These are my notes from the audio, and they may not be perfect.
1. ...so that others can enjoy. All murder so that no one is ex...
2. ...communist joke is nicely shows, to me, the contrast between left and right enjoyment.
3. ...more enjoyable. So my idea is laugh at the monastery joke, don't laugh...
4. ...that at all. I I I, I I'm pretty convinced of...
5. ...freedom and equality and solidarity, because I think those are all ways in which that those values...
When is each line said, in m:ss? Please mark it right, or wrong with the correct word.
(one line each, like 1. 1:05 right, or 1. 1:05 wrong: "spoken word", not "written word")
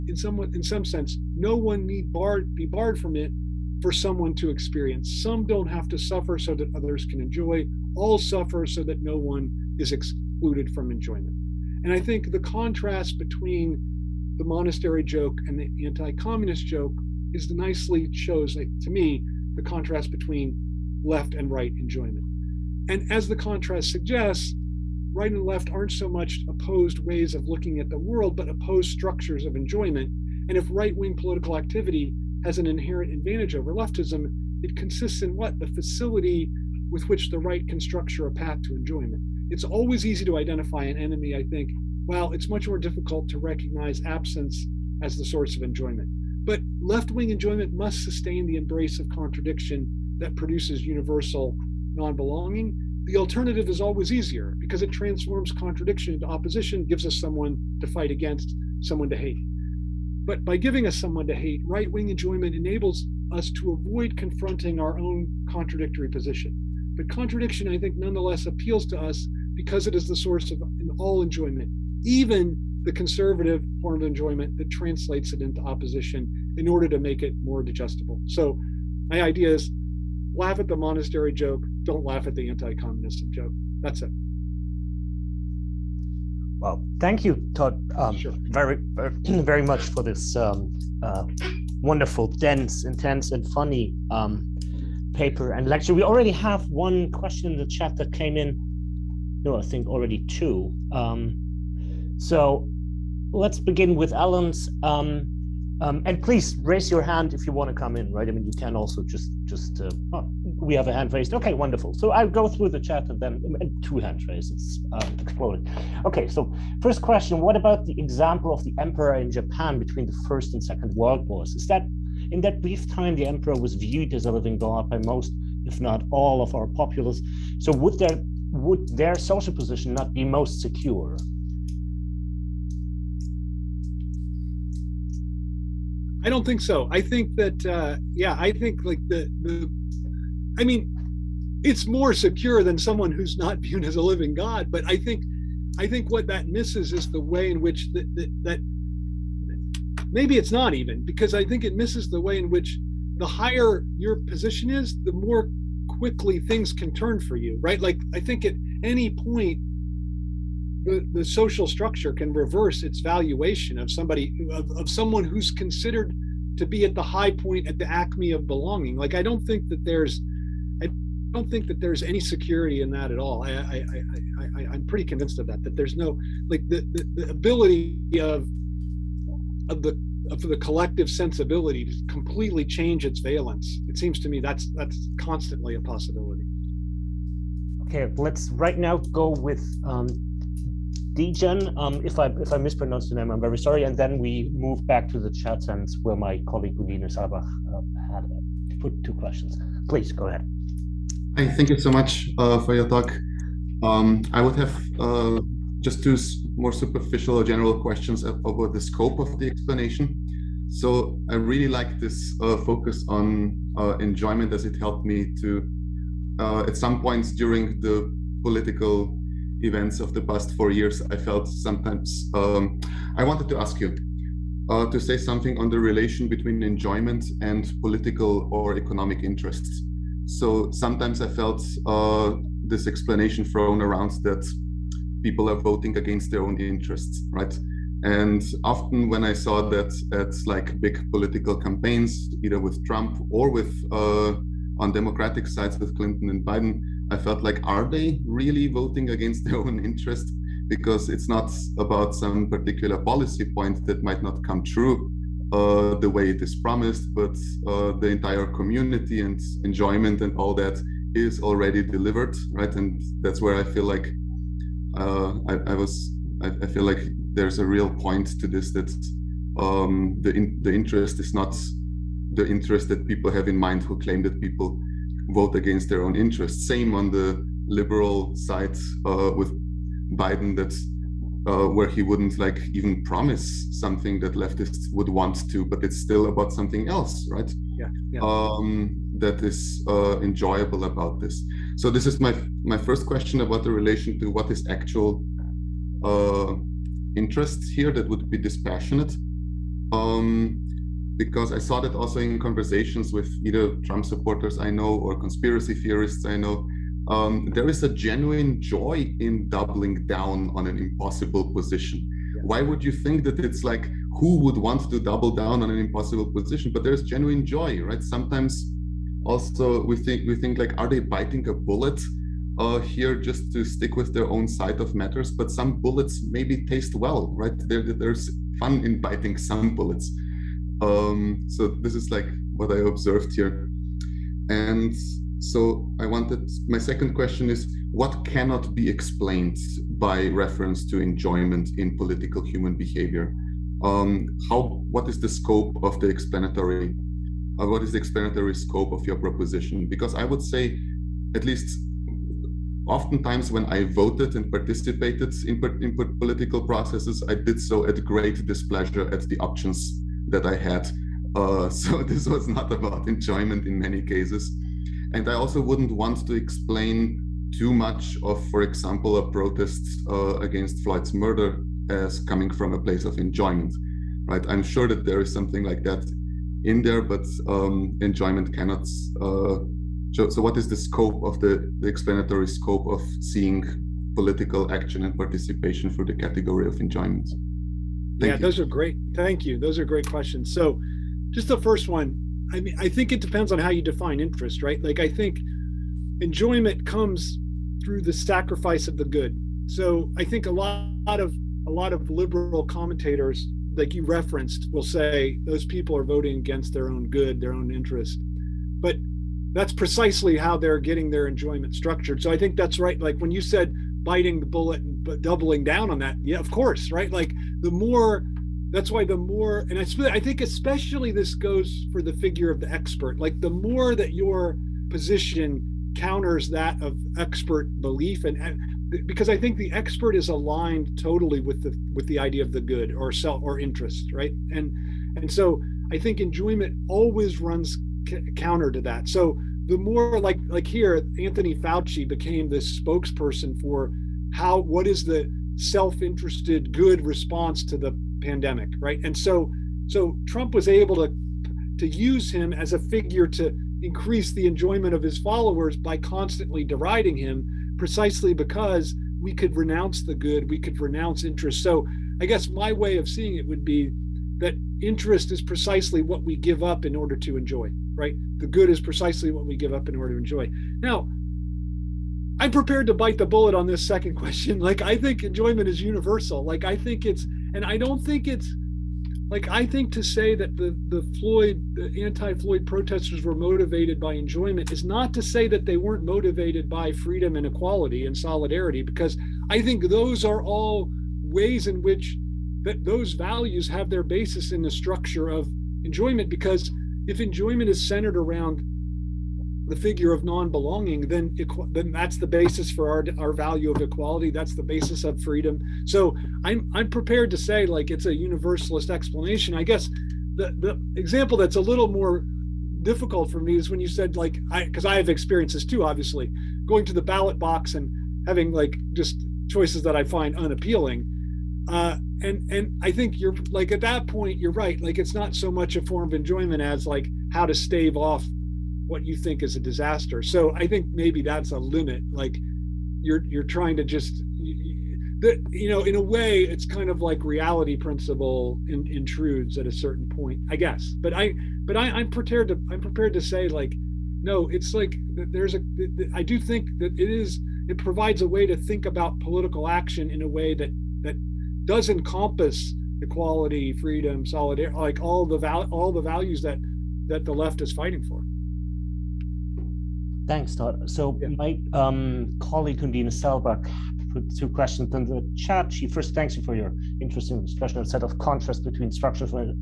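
1. 0:06 wrong: "suffer", not "murder"
2. 0:16 right
3. 1:17 wrong: "digestible", not "enjoyable"
4. 2:52 right
5. 8:06 right.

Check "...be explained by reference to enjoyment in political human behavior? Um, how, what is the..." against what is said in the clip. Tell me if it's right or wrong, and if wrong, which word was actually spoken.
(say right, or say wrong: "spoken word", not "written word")
right.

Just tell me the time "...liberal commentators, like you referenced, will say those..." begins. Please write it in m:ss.
6:42.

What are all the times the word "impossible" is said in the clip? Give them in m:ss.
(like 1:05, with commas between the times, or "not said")
5:10, 5:15.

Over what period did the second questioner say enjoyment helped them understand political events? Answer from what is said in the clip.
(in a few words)
the past four years.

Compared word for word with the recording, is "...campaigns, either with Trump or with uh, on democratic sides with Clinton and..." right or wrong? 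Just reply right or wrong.
right.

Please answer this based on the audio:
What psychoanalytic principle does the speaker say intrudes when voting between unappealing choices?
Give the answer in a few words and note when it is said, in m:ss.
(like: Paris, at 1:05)
reality principle, at 8:57.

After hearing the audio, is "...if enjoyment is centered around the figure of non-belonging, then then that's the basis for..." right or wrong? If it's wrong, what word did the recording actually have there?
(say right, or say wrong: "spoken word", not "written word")
right.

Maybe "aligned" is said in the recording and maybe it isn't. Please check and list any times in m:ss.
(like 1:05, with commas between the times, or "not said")
7:10.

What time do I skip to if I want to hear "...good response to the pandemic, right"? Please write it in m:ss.
7:26.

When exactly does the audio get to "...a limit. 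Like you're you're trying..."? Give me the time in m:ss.
8:51.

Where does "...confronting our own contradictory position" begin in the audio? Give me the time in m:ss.
1:04.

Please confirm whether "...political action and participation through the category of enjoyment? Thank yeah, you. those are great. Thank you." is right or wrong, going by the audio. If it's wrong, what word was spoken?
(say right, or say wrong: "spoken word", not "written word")
right.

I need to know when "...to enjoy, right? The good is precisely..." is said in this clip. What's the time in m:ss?
7:47.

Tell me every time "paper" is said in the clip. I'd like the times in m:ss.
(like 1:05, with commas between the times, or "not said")
1:35.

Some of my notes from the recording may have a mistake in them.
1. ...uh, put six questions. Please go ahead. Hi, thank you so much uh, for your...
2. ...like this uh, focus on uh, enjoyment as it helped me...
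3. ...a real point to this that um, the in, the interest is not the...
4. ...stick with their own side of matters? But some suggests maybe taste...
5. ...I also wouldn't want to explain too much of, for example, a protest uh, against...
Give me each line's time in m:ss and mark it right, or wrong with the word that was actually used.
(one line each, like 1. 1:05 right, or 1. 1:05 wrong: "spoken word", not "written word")
1. 3:18 wrong: "two", not "six"
2. 3:31 right
3. 4:27 right
4. 5:23 wrong: "bullets", not "suggests"
5. 6:05 right.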